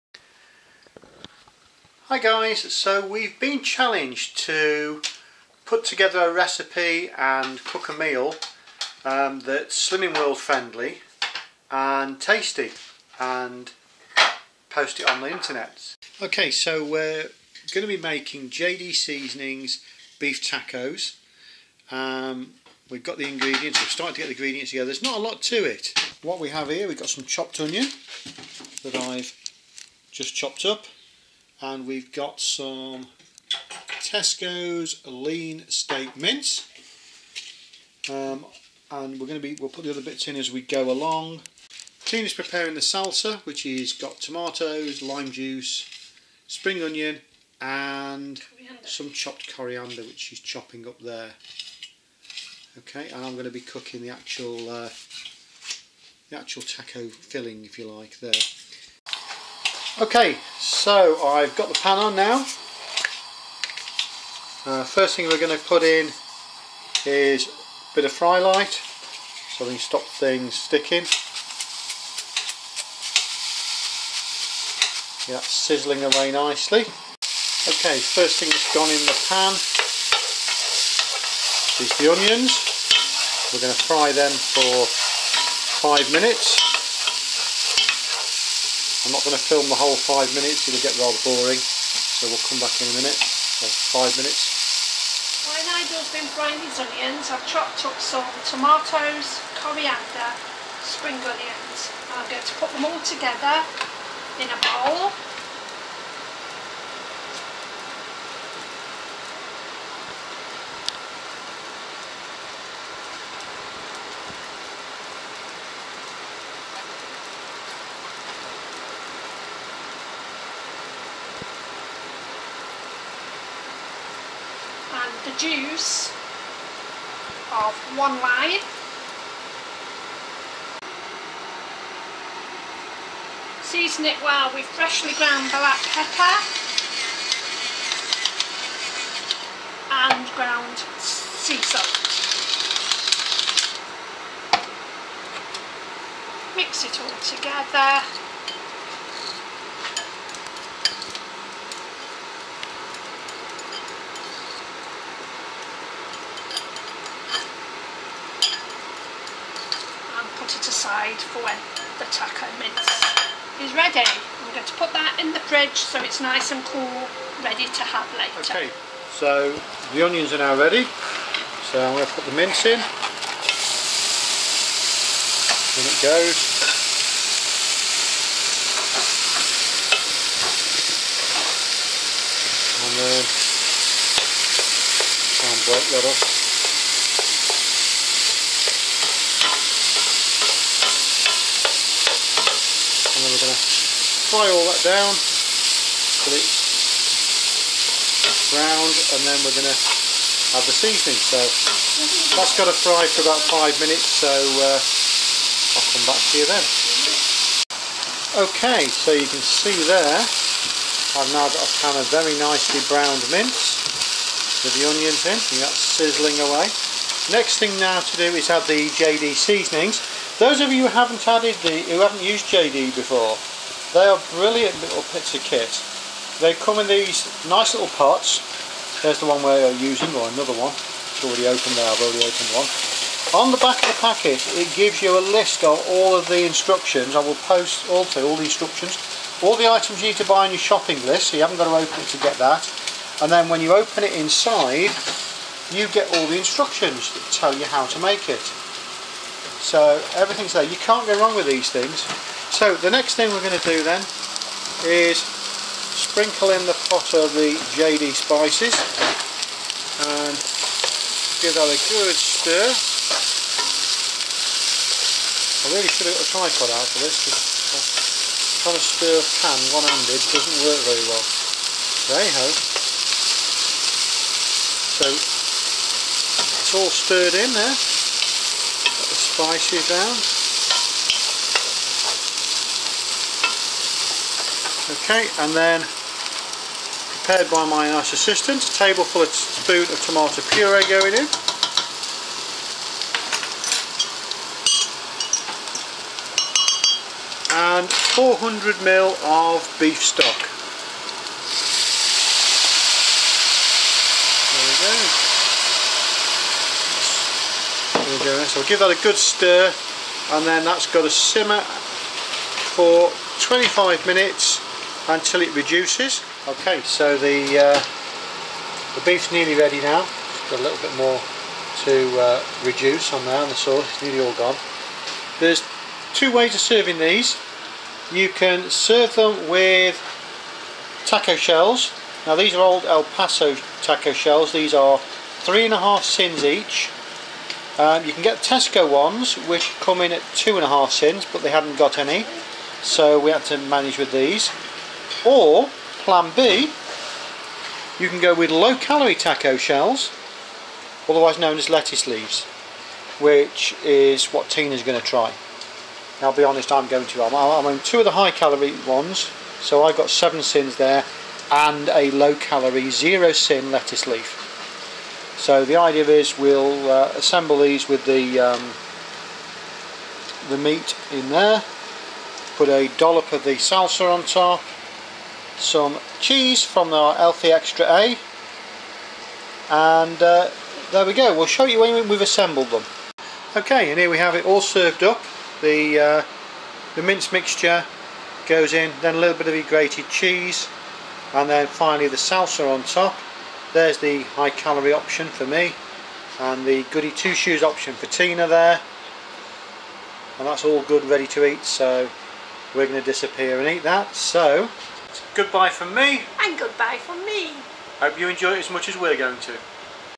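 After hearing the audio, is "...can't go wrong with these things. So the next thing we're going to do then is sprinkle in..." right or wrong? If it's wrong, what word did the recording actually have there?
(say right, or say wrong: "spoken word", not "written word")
right.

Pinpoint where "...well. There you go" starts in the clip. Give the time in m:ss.
4:31.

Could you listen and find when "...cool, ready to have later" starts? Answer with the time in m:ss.
2:46.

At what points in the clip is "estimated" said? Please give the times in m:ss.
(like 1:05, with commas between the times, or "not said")
not said.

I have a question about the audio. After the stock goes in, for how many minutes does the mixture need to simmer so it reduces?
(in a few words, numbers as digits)
25.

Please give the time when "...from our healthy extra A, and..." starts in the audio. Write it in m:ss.
6:16.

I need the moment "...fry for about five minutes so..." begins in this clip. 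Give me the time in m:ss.
3:22.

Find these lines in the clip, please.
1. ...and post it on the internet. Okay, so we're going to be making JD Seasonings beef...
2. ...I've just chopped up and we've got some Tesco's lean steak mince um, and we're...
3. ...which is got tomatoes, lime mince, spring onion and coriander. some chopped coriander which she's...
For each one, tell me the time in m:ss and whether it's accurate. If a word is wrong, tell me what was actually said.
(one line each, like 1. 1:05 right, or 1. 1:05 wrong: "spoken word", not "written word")
1. 0:13 right
2. 0:28 right
3. 0:43 wrong: "juice", not "mince".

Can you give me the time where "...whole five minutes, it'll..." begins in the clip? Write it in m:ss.
1:29.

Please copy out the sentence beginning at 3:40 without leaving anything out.
Those of you who haven't added the, who haven't used JD before, they are brilliant little bits kit.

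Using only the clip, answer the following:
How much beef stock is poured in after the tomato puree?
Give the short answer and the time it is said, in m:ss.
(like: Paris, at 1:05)
400 ml, at 4:57.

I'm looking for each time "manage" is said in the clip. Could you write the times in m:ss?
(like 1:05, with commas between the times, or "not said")
5:43.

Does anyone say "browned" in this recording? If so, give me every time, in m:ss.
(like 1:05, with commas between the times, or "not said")
3:18, 3:32.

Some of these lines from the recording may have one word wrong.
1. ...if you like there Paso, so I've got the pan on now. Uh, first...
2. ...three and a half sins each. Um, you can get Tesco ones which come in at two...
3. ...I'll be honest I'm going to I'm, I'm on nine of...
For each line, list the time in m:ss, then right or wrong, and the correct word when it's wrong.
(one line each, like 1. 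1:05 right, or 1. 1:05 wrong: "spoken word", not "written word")
1. 0:57 wrong: "Okay", not "Paso"
2. 5:35 right
3. 5:56 wrong: "two", not "nine".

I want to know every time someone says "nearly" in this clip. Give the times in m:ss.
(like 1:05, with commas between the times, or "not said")
5:19, 5:24.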